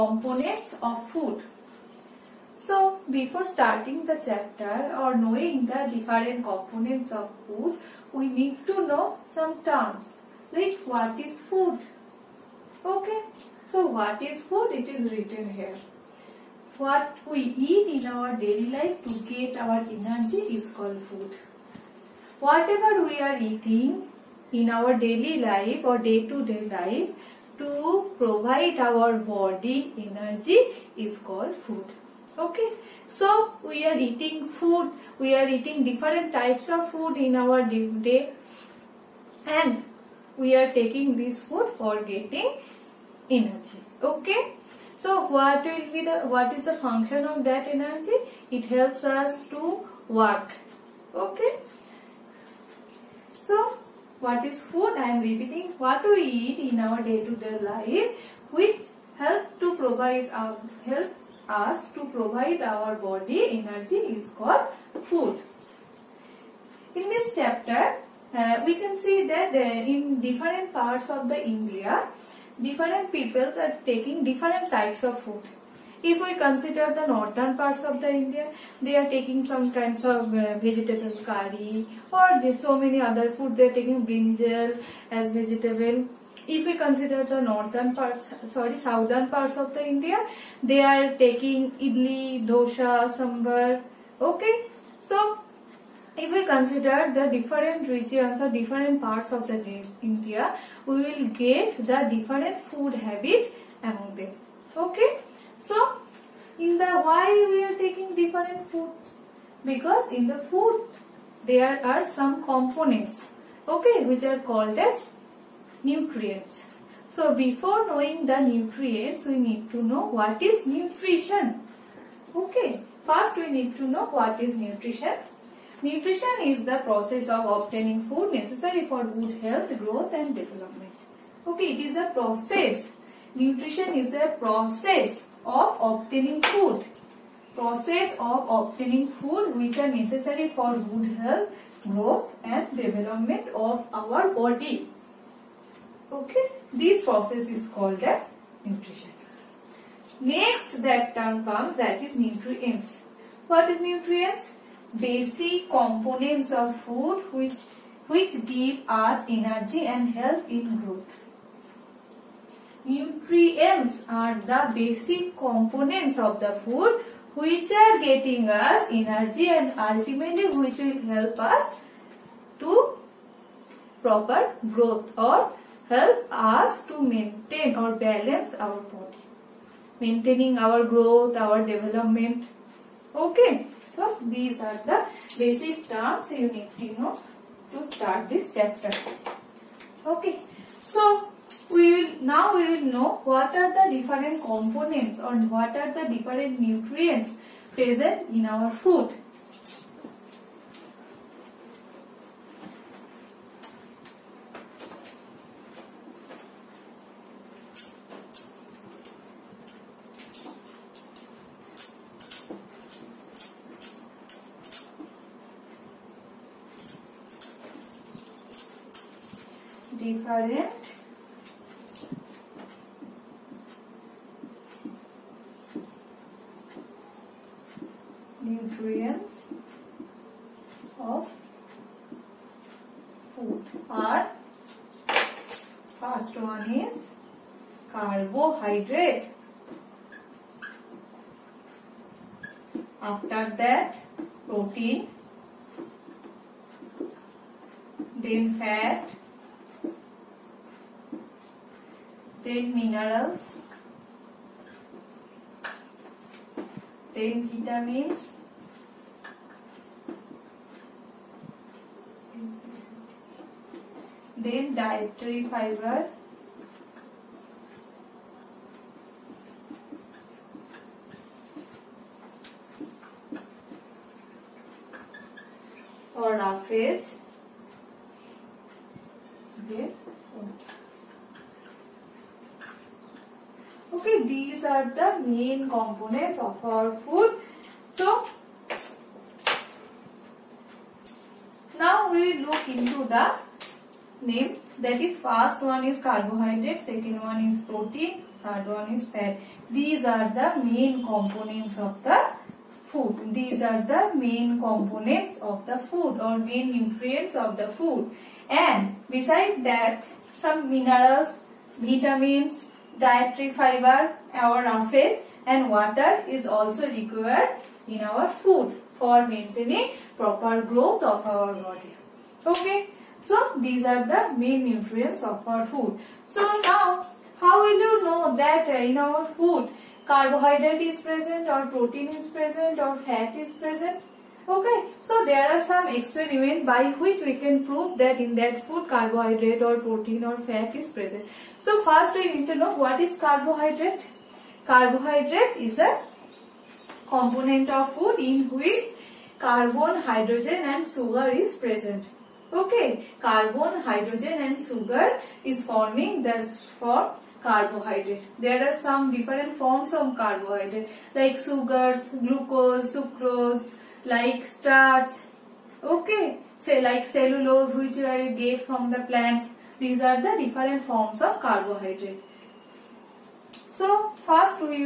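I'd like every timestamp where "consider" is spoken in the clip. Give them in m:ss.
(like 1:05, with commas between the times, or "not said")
1:16, 1:26, 1:36.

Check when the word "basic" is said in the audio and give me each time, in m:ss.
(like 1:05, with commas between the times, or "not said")
2:34, 2:44, 3:05.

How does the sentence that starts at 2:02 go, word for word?
Okay, first we need to know what is nutrition.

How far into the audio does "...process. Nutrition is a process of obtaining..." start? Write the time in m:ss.
2:12.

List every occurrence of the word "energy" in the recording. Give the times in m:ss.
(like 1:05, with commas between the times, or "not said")
0:19, 0:29, 0:43, 0:47, 1:03, 2:39, 2:48.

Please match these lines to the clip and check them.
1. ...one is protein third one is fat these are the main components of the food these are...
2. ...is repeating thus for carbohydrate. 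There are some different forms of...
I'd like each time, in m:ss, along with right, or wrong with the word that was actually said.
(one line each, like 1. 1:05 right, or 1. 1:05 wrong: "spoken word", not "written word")
1. 4:57 right
2. 5:55 wrong: "forming", not "repeating".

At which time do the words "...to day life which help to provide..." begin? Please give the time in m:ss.
0:57.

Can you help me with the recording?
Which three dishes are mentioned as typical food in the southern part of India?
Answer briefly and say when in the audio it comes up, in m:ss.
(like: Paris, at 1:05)
Idli, dosa, sambar, at 1:31.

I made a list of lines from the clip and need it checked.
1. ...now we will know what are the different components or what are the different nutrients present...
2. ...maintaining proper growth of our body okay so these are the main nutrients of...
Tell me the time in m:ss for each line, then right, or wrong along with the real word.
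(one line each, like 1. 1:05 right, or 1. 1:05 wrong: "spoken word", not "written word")
1. 3:12 right
2. 5:19 right.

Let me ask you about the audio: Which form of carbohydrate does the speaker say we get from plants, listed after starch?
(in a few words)
Cellulose.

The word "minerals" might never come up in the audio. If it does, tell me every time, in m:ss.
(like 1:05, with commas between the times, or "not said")
4:12, 5:10.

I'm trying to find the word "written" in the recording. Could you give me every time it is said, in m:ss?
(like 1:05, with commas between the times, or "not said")
0:15.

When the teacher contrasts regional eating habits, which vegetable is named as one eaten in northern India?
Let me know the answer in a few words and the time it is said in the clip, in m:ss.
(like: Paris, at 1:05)
Brinjal, at 1:24.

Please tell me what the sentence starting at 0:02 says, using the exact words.
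So before starting the chapter or knowing the different components of food we need to know some terms like what is food?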